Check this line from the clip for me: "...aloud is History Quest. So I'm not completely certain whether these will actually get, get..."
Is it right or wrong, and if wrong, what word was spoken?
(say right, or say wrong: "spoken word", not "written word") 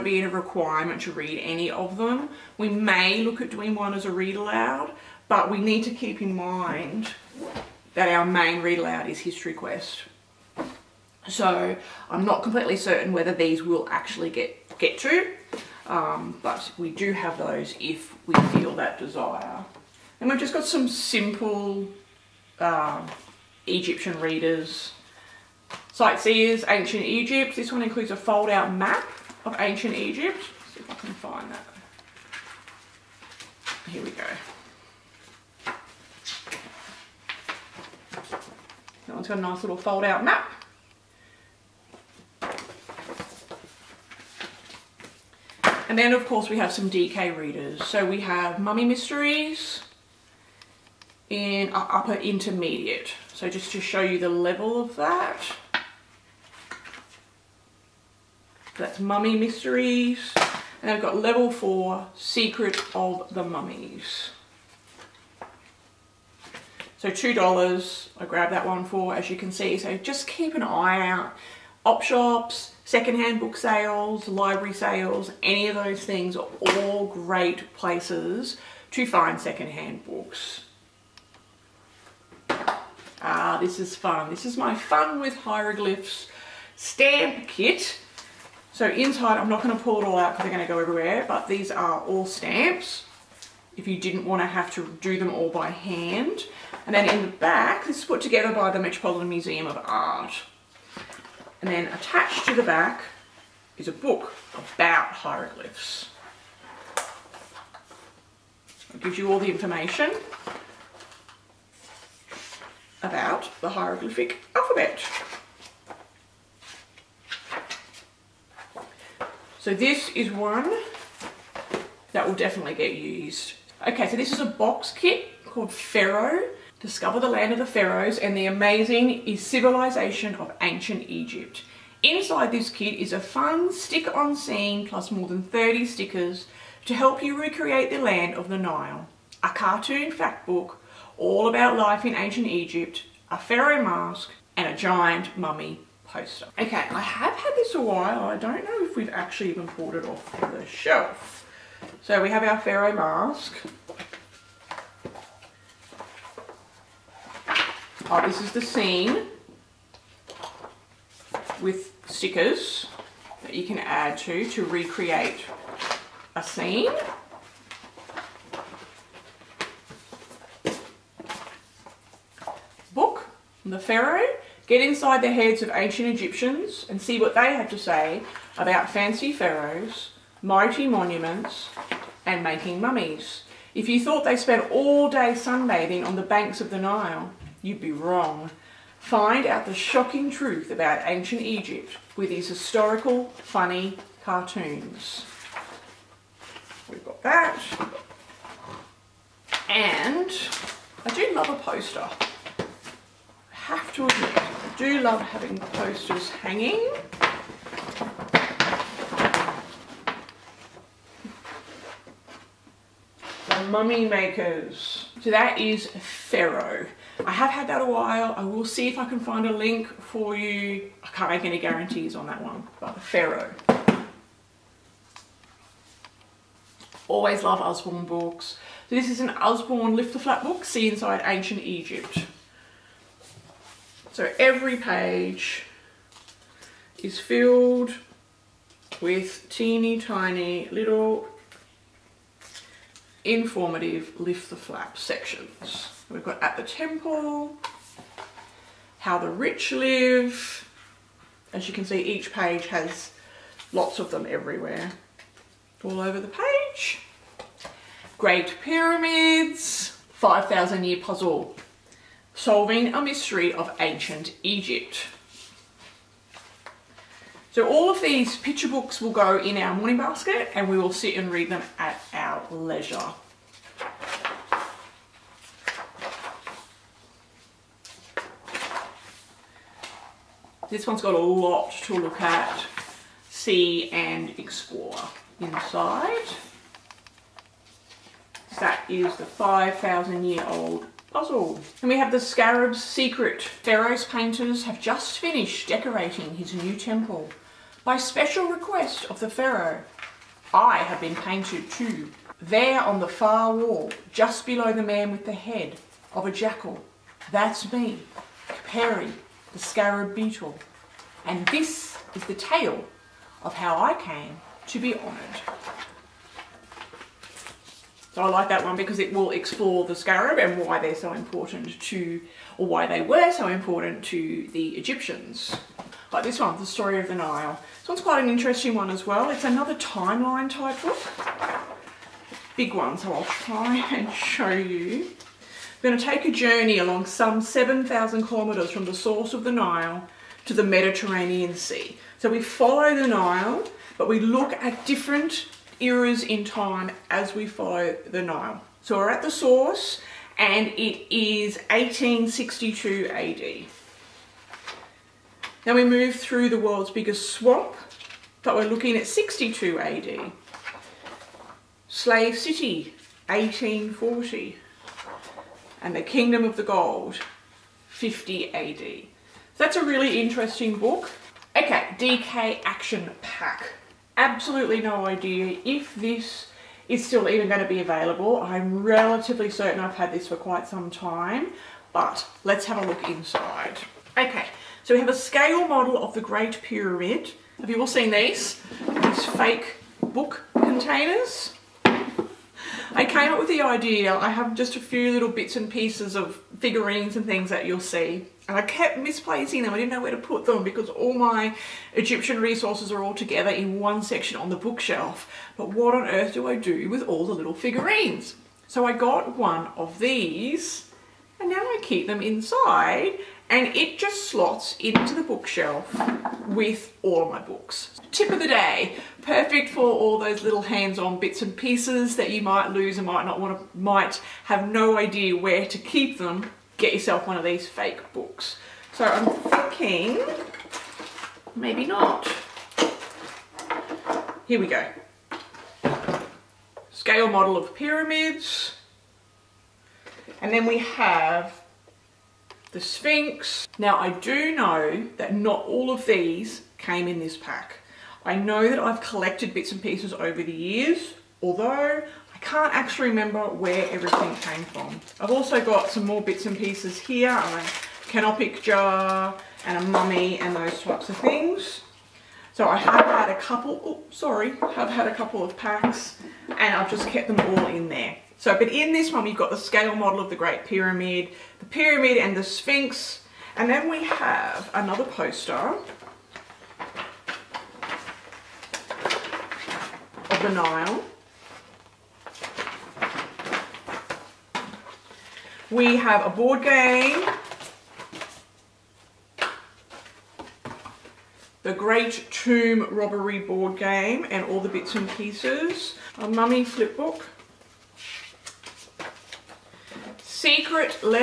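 right.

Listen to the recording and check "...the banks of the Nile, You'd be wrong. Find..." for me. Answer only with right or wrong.
right.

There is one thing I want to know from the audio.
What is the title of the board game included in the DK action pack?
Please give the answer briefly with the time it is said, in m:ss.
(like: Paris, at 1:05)
The Great Tomb Robbery, at 8:11.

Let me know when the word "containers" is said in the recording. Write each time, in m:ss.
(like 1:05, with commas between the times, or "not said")
6:30.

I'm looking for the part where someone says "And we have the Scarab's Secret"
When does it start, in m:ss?
4:51.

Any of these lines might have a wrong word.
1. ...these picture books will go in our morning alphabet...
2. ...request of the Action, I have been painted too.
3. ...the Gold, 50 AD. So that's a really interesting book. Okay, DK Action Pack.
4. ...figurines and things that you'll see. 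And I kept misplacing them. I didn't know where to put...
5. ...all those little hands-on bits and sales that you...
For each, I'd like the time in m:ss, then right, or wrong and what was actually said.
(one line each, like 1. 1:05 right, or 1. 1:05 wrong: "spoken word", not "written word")
1. 4:28 wrong: "basket", not "alphabet"
2. 4:58 wrong: "Pharaoh", not "Action"
3. 6:06 right
4. 6:36 right
5. 6:59 wrong: "pieces", not "sales".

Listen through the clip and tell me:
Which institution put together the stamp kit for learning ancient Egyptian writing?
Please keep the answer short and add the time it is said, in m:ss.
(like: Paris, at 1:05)
Metropolitan Museum of Art, at 1:38.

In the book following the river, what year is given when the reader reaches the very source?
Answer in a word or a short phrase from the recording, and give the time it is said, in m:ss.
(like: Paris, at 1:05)
1862 AD, at 5:51.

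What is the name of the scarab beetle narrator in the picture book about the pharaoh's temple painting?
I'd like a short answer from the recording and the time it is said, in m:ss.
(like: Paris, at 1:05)
Perry, at 5:08.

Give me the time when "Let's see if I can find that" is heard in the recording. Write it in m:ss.
0:30.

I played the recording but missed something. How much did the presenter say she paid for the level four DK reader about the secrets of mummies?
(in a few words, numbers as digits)
$2.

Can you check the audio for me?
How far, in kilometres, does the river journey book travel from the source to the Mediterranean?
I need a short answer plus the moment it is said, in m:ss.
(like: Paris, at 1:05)
7,000 kilometres, at 5:37.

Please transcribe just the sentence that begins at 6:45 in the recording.
But what on earth do I do with all the little figurines?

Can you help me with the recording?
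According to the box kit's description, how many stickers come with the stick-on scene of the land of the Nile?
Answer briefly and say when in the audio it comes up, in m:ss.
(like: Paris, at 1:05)
more than 30, at 2:15.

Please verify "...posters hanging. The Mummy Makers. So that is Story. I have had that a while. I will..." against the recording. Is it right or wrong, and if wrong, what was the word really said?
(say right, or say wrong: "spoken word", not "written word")
wrong: "Pharaoh", not "Story".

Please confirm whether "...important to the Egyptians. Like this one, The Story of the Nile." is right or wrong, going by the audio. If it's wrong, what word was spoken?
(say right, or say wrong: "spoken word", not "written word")
right.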